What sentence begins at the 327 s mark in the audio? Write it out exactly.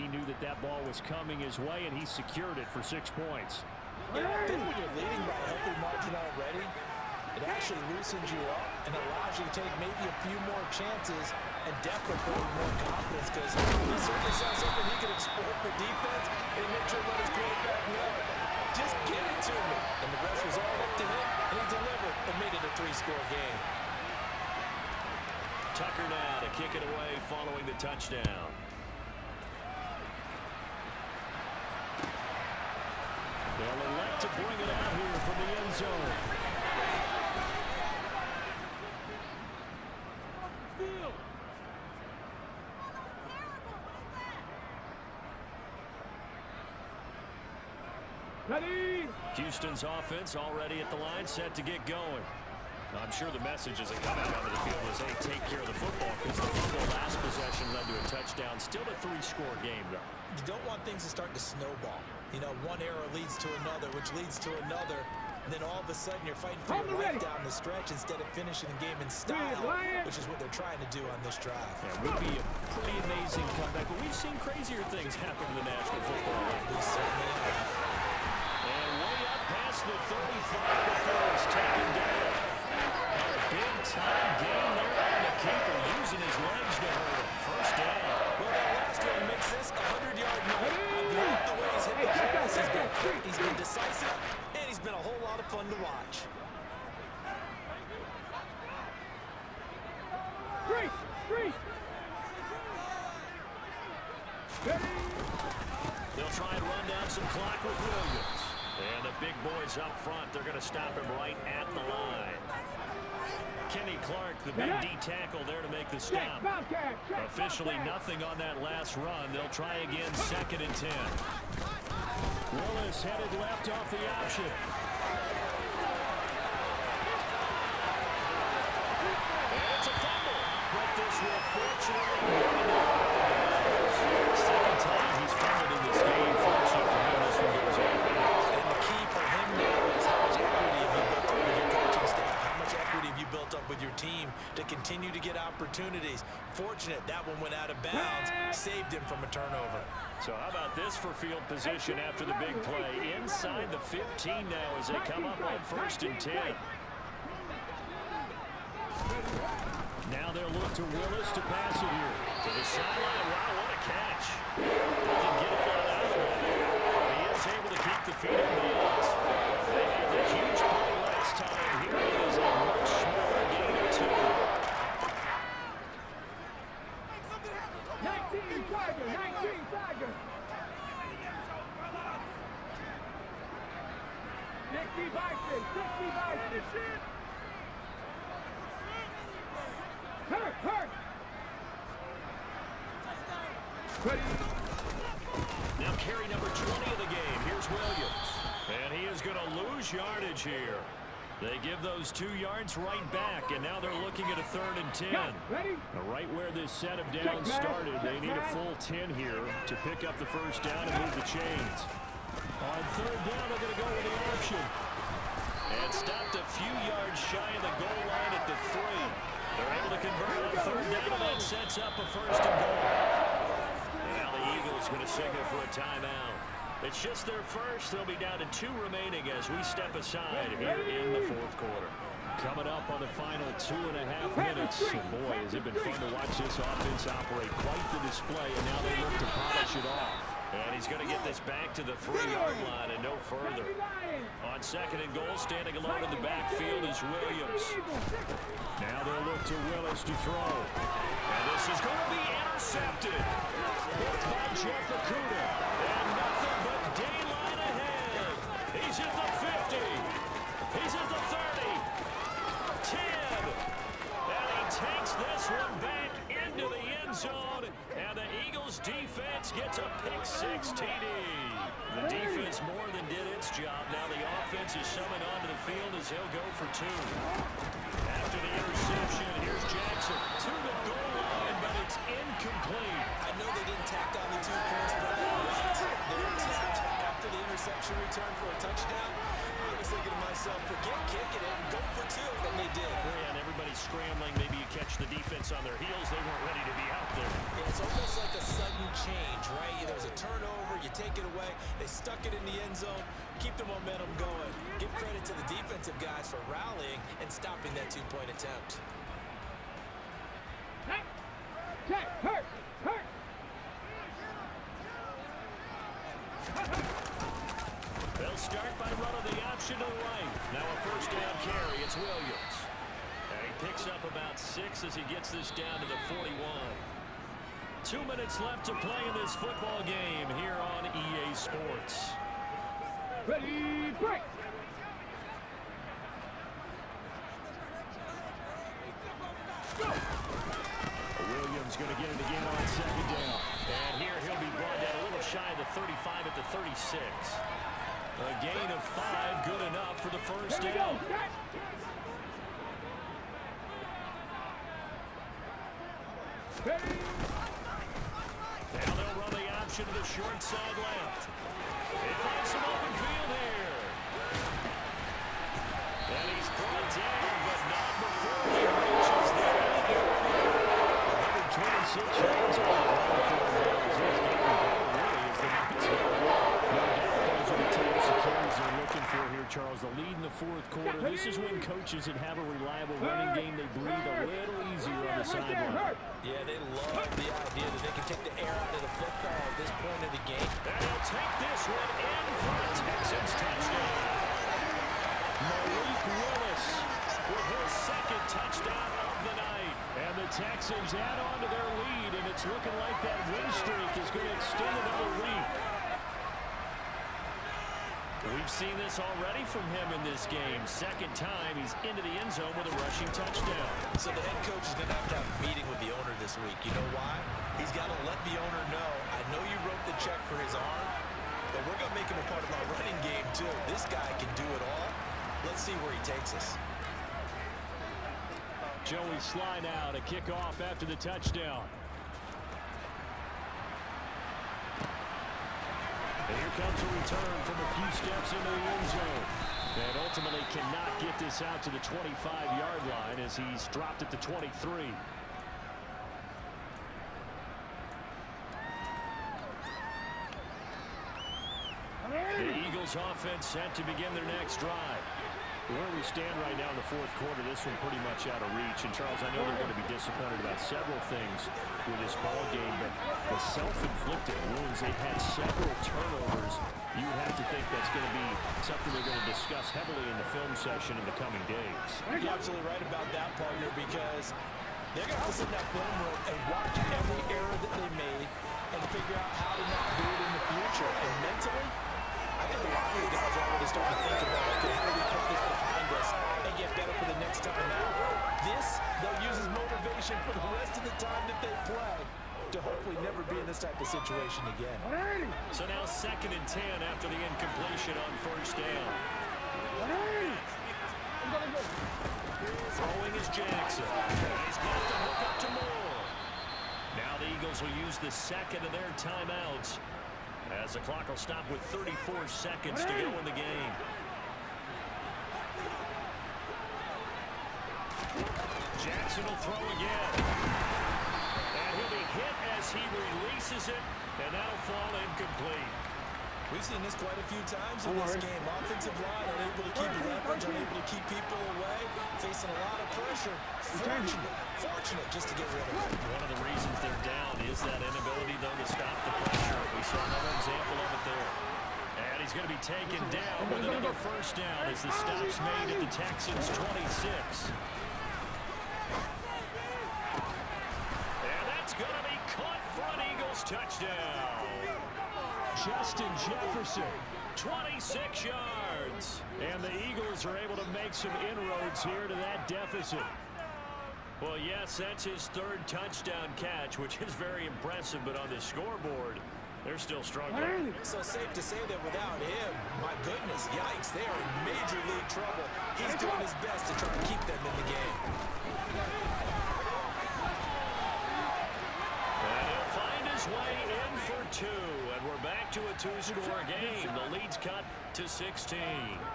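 Two minutes left to play in this football game here on EA Sports.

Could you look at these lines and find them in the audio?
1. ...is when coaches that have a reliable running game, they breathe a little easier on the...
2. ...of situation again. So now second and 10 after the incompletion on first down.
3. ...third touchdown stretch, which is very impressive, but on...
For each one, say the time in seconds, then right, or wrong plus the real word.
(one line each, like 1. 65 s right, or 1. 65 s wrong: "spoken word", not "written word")
1. 381 s right
2. 493 s right
3. 565 s wrong: "catch", not "stretch".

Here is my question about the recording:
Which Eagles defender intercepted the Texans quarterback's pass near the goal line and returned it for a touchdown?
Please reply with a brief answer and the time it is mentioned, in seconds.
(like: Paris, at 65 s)
Jeff Okudah, at 254 s.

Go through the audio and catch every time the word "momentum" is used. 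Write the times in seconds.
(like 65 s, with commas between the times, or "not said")
303 s.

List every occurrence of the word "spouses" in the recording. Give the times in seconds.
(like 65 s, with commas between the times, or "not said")
not said.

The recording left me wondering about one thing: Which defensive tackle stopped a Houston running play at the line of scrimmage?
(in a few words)
Kenny Clark.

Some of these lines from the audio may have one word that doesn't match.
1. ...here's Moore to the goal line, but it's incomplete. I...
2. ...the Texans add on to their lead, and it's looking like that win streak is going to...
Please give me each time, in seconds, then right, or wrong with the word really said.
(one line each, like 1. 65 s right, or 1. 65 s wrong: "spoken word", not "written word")
1. 279 s wrong: "Jackson", not "Moore"
2. 400 s right.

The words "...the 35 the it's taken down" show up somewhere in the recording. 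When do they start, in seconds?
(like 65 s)
79 s.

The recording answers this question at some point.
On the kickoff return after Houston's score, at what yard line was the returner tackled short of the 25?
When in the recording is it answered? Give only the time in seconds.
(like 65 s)
444 s.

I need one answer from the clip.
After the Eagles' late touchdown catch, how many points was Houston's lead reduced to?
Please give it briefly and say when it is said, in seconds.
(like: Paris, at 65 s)
16, at 588 s.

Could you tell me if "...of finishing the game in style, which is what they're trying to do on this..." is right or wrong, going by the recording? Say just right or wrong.
right.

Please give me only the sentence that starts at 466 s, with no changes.
You have to think that's going to be something they're going to discuss heavily in the film session in the coming days.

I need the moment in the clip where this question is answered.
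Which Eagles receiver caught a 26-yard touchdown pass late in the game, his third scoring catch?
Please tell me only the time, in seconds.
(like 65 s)
555 s.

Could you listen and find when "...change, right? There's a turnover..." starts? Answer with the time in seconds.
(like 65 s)
299 s.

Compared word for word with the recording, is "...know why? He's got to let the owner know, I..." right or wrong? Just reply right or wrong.
right.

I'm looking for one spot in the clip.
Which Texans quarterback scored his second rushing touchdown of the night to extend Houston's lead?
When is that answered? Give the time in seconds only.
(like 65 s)
395 s.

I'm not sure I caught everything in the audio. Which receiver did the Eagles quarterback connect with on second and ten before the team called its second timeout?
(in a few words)
Moore.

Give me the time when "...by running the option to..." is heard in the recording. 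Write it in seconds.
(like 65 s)
318 s.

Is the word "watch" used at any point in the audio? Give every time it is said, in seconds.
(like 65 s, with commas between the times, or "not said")
95 s, 236 s, 476 s.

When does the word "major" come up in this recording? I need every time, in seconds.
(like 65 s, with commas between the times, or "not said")
574 s.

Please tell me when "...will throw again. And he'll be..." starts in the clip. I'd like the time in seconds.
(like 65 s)
519 s.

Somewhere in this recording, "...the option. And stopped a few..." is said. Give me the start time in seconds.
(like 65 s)
214 s.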